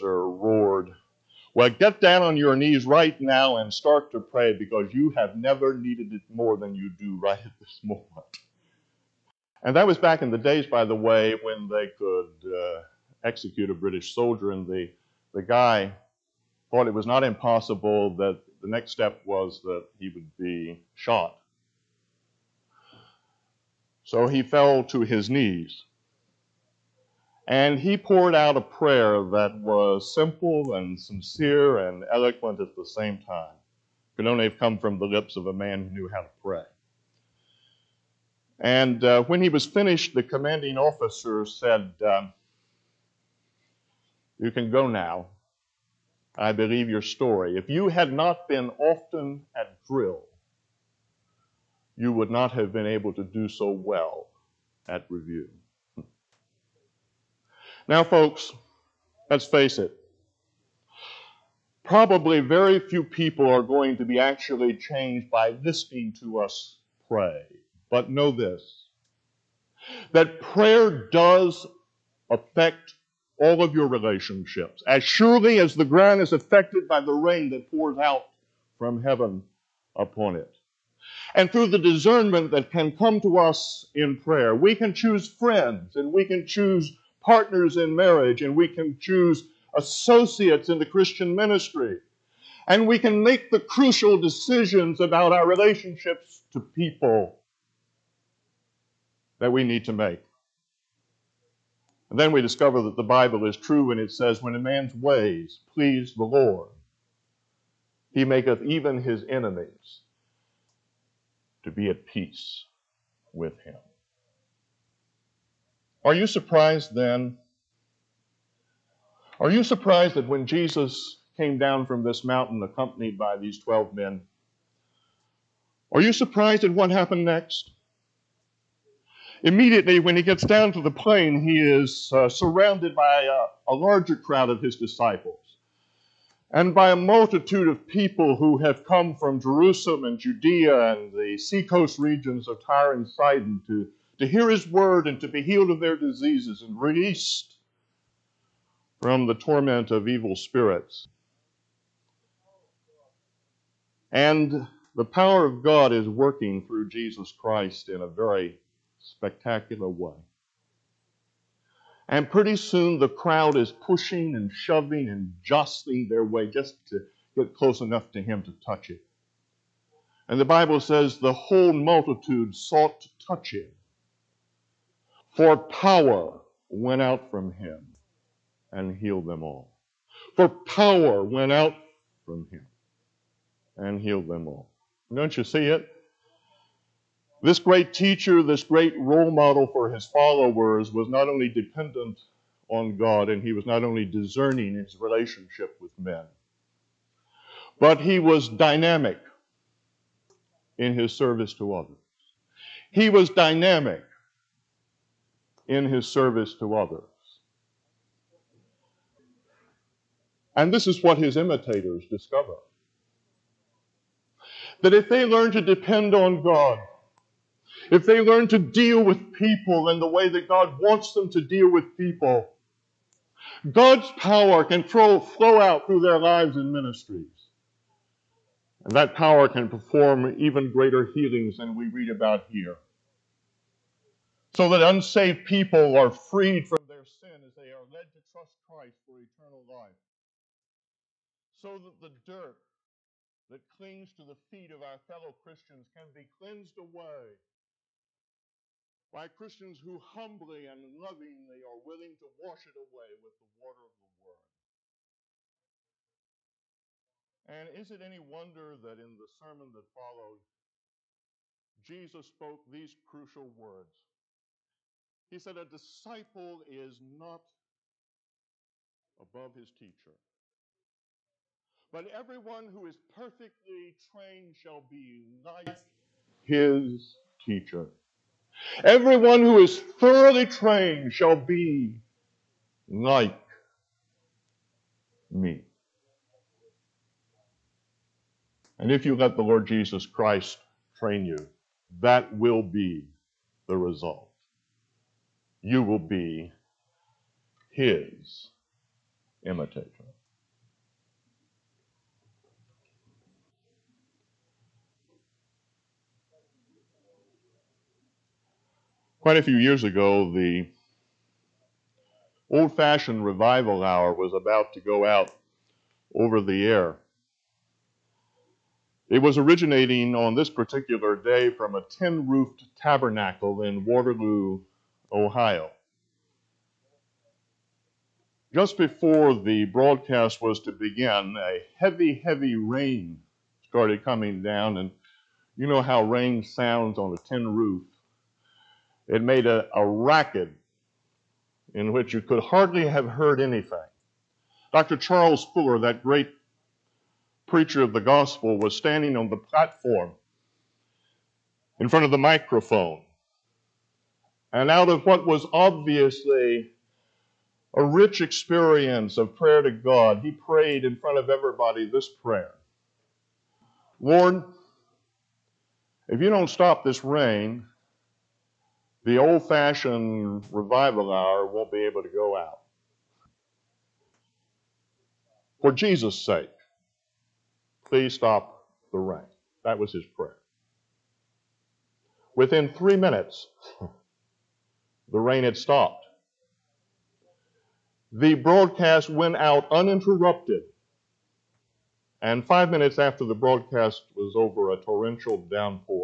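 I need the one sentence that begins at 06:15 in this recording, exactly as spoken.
For Jesus' sake, please stop the rain.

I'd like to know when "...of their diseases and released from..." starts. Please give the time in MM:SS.
02:25.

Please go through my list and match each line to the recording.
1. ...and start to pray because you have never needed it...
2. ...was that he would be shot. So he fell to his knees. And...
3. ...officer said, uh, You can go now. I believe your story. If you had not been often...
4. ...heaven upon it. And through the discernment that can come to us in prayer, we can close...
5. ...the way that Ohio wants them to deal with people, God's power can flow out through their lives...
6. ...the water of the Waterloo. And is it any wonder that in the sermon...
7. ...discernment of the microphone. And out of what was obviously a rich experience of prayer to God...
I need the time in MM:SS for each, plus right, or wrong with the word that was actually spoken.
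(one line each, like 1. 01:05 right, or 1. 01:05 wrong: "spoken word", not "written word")
1. 00:03 right
2. 00:19 right
3. 00:40 right
4. 01:19 wrong: "choose", not "close"
5. 03:40 wrong: "God", not "Ohio"
6. 04:13 wrong: "Word", not "Waterloo"
7. 05:51 wrong: "front", not "discernment".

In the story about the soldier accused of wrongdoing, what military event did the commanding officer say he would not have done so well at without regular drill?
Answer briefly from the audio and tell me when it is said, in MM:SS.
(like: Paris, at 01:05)
Review, at 00:55.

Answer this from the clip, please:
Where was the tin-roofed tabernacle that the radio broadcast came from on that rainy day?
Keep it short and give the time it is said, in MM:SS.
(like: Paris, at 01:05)
Waterloo, Ohio, at 05:23.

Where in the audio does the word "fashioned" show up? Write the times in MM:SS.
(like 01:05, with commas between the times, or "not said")
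05:12, 06:09.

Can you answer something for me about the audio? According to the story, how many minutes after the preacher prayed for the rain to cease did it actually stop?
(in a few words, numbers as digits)
3.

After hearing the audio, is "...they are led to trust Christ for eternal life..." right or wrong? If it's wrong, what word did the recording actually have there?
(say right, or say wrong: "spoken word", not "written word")
right.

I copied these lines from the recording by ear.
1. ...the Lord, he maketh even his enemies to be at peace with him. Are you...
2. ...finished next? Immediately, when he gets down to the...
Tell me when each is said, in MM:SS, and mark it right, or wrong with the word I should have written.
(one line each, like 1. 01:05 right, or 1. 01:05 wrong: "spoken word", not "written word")
1. 01:46 right
2. 02:06 wrong: "happened", not "finished".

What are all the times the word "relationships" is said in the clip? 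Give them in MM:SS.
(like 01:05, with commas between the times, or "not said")
01:13, 01:35, 03:15.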